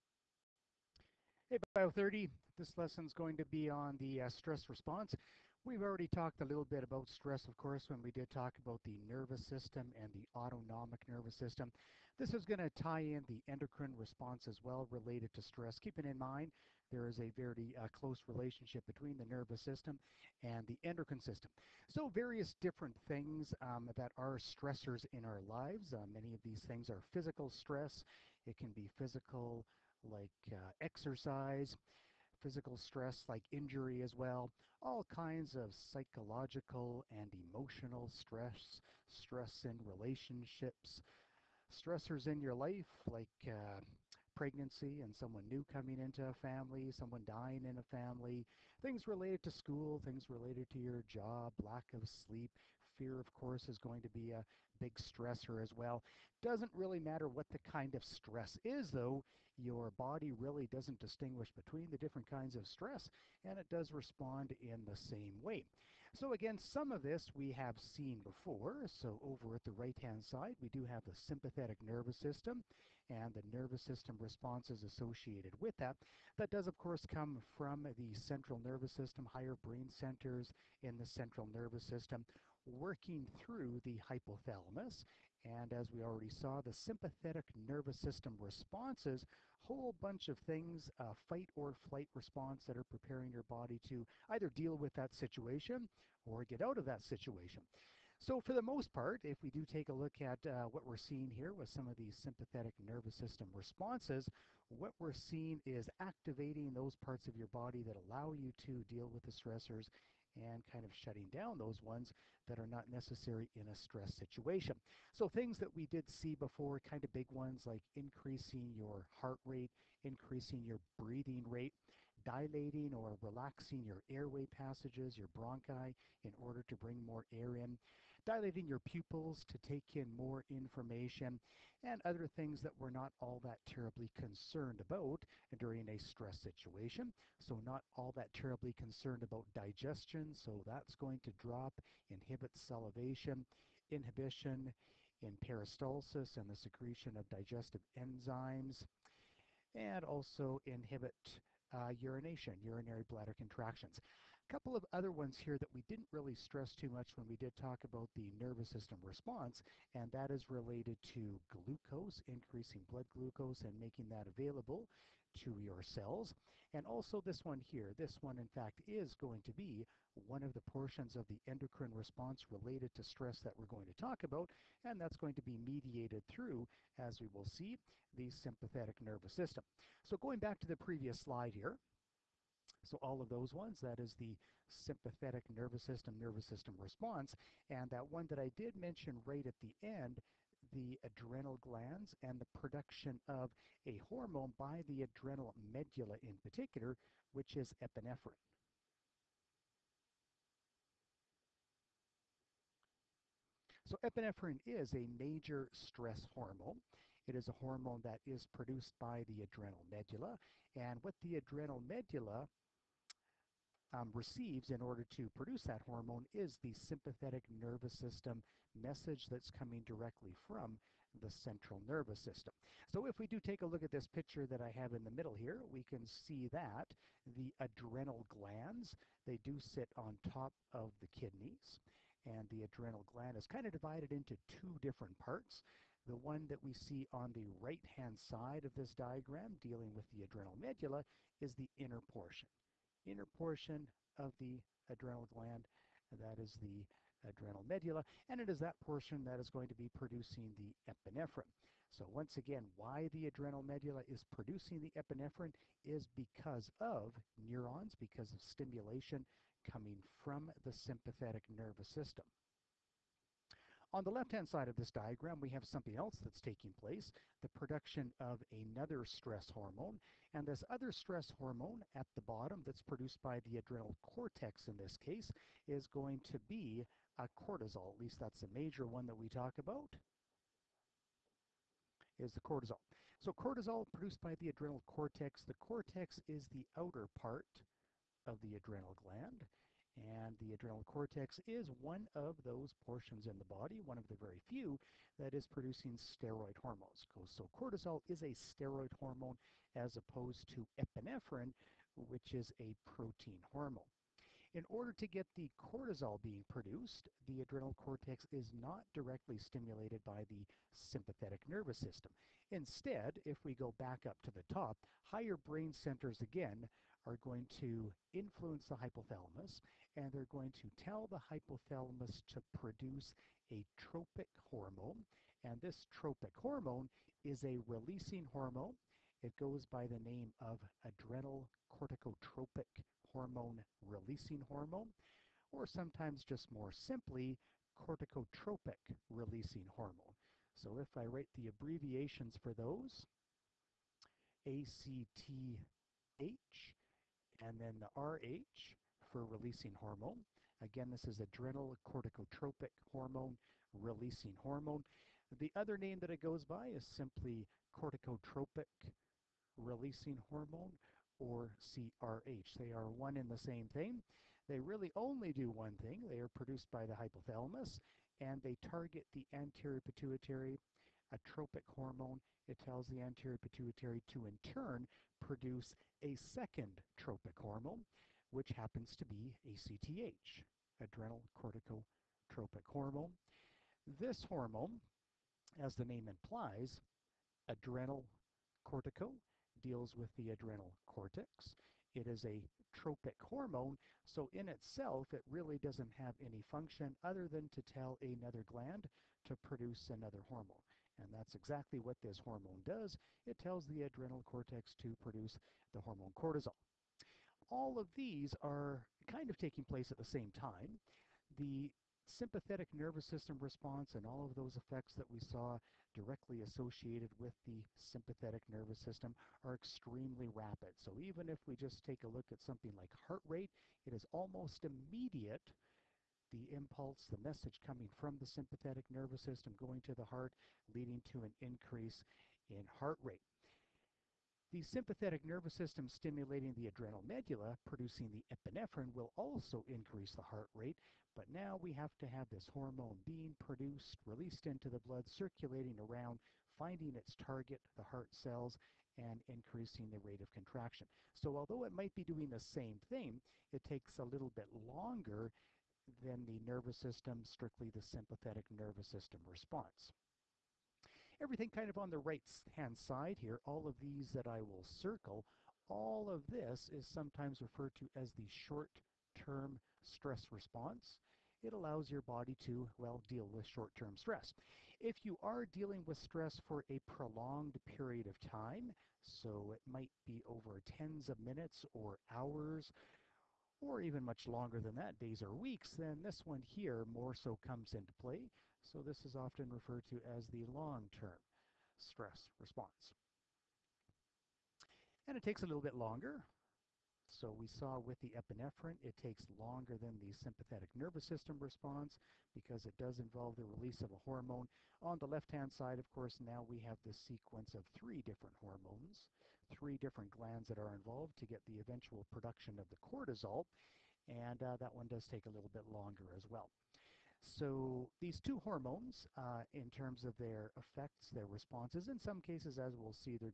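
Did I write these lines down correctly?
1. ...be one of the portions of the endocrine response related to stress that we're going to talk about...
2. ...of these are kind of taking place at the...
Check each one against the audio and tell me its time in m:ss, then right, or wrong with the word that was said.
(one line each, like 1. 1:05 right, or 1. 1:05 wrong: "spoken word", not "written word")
1. 2:49 right
2. 6:47 right.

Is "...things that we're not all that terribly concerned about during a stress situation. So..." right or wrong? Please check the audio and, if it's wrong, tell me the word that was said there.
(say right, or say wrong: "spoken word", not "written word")
right.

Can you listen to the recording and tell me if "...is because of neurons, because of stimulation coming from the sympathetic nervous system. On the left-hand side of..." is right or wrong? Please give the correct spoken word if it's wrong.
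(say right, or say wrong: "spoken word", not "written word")
right.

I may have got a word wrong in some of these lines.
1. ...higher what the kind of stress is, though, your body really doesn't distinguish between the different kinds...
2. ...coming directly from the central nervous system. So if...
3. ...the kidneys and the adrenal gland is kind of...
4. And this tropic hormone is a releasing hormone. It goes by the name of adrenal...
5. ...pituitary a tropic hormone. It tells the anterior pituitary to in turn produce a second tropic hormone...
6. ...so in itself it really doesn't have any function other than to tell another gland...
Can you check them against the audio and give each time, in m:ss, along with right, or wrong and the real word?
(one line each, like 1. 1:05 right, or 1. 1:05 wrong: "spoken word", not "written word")
1. 0:56 wrong: "matter", not "higher"
2. 3:39 right
3. 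3:51 right
4. 5:25 right
5. 6:09 right
6. 6:34 right.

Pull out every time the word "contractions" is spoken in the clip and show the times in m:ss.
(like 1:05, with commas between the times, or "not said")
2:33, 7:30.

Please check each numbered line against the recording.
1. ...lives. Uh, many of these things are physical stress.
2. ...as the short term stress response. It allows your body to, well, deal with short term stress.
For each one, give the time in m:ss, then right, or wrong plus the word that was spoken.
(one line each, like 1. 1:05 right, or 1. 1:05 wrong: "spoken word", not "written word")
1. 0:25 right
2. 7:48 right.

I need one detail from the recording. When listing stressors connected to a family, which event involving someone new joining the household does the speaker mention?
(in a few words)
pregnancy.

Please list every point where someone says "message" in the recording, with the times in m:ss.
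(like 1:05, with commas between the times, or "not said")
3:38, 7:07.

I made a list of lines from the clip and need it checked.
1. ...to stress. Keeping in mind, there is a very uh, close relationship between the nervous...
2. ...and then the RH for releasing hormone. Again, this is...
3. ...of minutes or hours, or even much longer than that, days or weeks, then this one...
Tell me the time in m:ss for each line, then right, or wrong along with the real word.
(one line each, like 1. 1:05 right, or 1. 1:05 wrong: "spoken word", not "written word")
1. 0:15 right
2. 5:47 right
3. 8:01 right.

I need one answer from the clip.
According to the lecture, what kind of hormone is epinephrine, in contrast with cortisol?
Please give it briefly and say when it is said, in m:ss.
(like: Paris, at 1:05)
protein hormone, at 5:02.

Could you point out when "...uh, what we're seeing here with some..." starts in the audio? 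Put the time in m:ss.
1:40.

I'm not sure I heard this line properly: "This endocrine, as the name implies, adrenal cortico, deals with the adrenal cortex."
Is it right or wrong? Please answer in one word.
wrong.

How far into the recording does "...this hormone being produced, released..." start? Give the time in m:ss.
7:22.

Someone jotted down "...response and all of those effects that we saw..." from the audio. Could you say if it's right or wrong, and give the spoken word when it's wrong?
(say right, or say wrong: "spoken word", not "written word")
right.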